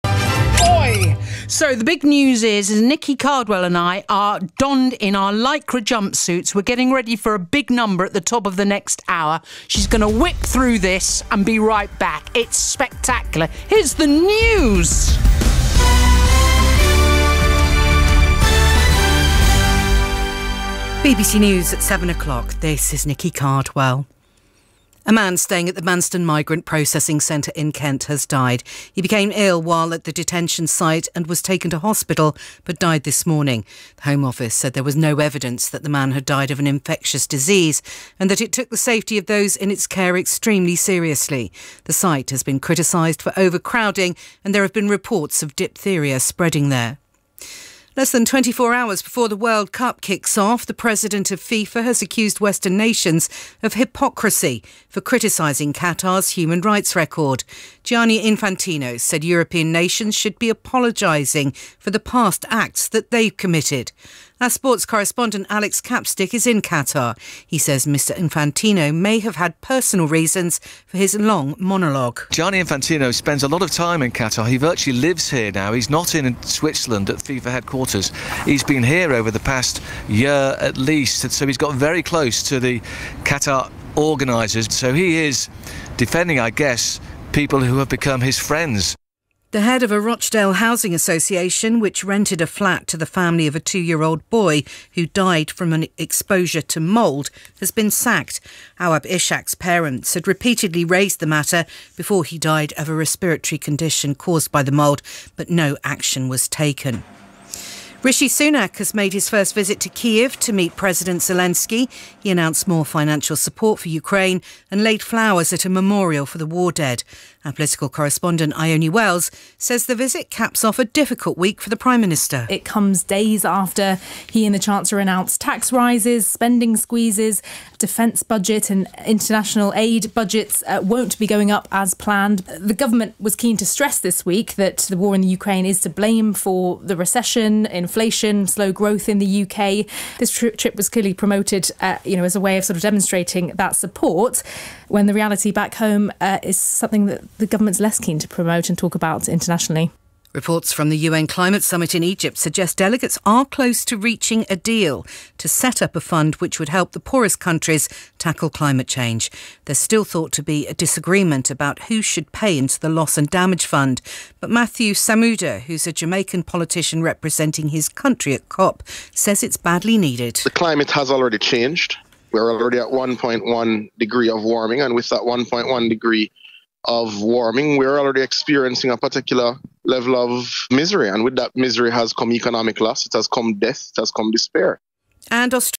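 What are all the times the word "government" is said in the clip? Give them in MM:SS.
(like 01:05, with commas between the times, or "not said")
02:12, 02:27.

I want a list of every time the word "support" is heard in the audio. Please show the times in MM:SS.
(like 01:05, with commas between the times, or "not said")
01:53, 02:23.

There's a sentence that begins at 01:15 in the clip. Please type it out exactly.
He's not in Switzerland at FIFA headquarters.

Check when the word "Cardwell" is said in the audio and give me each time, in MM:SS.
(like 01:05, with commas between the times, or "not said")
00:03, 00:23.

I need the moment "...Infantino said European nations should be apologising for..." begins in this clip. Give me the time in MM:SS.
00:58.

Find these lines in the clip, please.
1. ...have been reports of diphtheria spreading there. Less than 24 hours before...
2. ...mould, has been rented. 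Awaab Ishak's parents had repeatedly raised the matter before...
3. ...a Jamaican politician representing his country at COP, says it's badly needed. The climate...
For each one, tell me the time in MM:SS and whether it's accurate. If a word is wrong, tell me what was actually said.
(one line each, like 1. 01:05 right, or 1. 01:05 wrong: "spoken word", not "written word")
1. 00:44 right
2. 01:36 wrong: "sacked", not "rented"
3. 02:45 right.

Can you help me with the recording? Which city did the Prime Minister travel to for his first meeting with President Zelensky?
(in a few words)
Kiev.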